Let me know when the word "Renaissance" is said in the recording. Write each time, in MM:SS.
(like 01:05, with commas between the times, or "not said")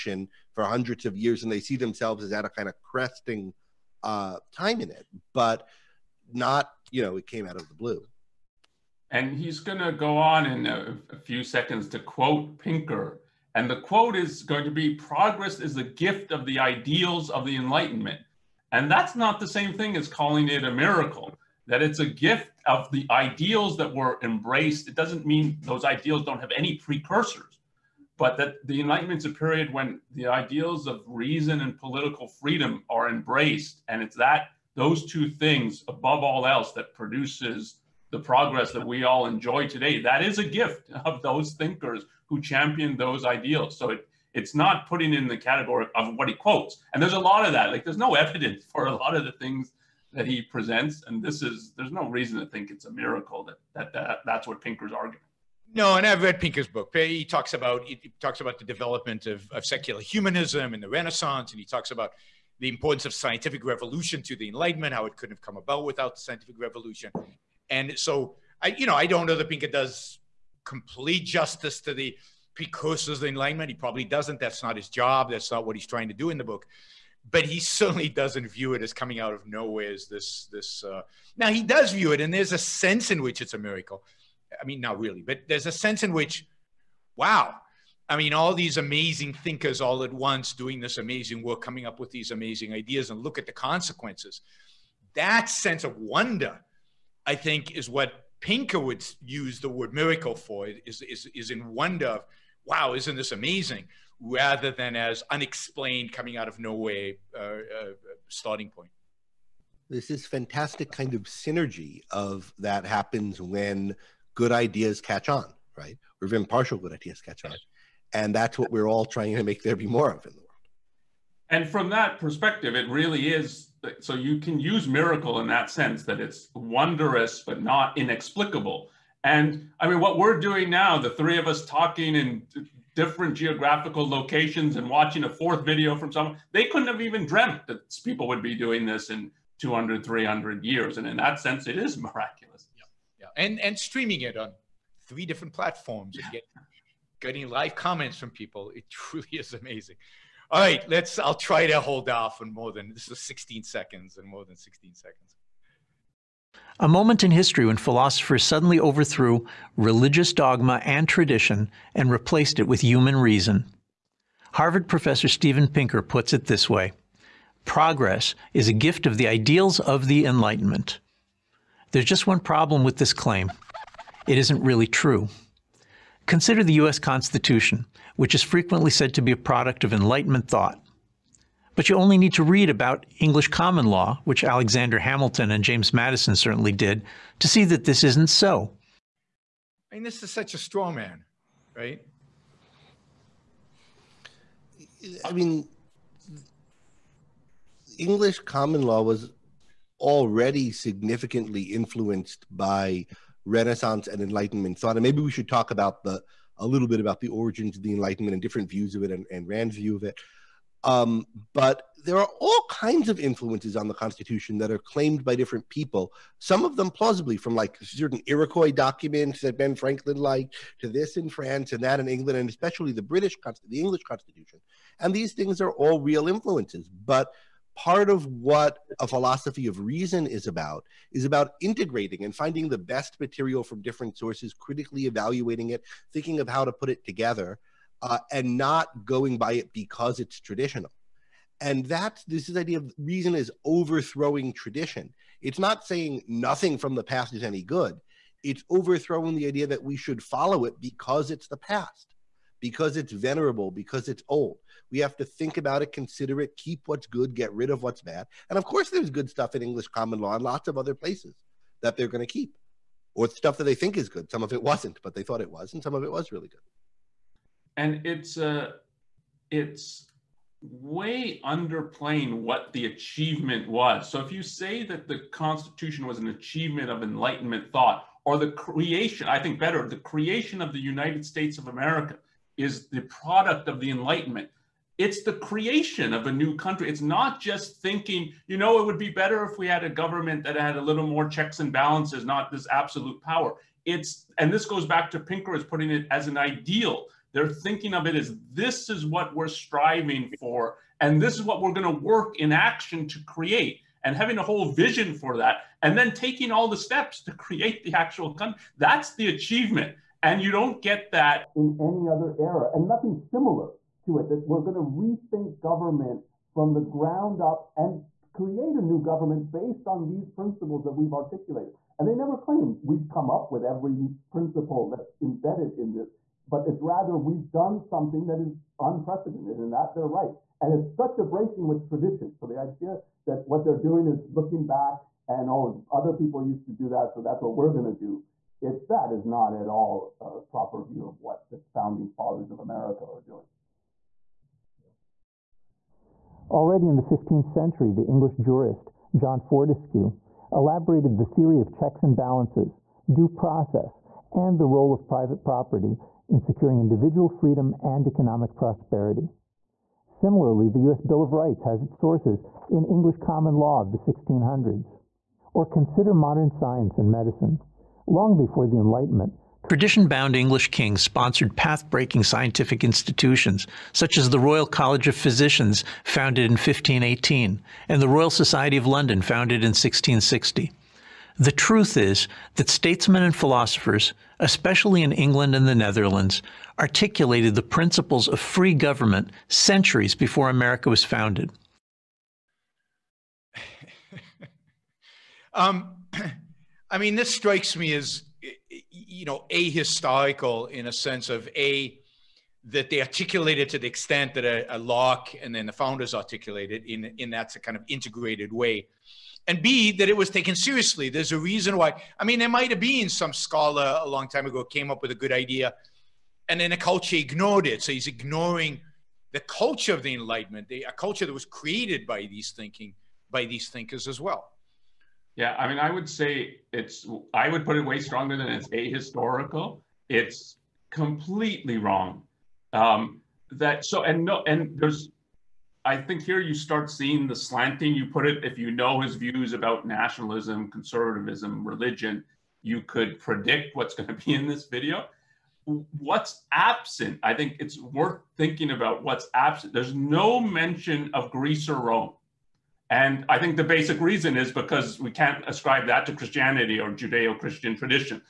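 01:00, 03:23.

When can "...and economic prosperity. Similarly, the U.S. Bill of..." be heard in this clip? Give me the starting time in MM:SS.
05:57.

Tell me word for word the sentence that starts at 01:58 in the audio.
And that's what we're all trying to make there be more of in the world.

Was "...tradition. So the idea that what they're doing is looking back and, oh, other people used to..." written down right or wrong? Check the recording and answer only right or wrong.
right.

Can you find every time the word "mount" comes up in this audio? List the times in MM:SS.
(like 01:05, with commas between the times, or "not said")
not said.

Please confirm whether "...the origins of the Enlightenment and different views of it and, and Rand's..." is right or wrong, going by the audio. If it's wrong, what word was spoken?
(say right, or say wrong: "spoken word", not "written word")
right.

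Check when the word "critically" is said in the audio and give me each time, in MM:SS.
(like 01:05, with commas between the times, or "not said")
03:54.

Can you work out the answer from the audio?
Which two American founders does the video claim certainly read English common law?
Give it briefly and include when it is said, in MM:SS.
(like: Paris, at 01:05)
Alexander Hamilton and James Madison, at 03:04.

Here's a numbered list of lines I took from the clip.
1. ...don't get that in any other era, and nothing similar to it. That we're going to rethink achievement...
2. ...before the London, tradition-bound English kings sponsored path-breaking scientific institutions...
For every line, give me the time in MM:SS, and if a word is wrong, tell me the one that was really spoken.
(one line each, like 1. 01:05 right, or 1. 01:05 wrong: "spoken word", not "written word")
1. 05:10 wrong: "government", not "achievement"
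2. 06:08 wrong: "Enlightenment", not "London".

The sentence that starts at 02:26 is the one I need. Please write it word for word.
and get, getting live comments from people.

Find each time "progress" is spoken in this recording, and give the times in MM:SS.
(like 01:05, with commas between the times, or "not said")
00:14, 00:38, 02:47.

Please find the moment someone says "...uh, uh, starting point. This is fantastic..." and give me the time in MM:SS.
01:47.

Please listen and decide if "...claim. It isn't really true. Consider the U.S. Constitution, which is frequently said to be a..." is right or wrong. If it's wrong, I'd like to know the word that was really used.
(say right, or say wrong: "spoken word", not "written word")
right.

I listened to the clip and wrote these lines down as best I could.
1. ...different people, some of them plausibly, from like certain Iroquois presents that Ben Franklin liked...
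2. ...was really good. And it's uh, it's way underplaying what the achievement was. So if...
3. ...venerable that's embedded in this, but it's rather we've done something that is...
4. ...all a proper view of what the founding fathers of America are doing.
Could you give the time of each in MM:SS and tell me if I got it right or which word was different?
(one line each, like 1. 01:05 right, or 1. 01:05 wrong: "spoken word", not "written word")
1. 03:35 wrong: "documents", not "presents"
2. 04:26 right
3. 05:24 wrong: "principle", not "venerable"
4. 05:39 right.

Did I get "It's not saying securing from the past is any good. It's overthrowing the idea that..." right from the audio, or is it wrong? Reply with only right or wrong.
wrong.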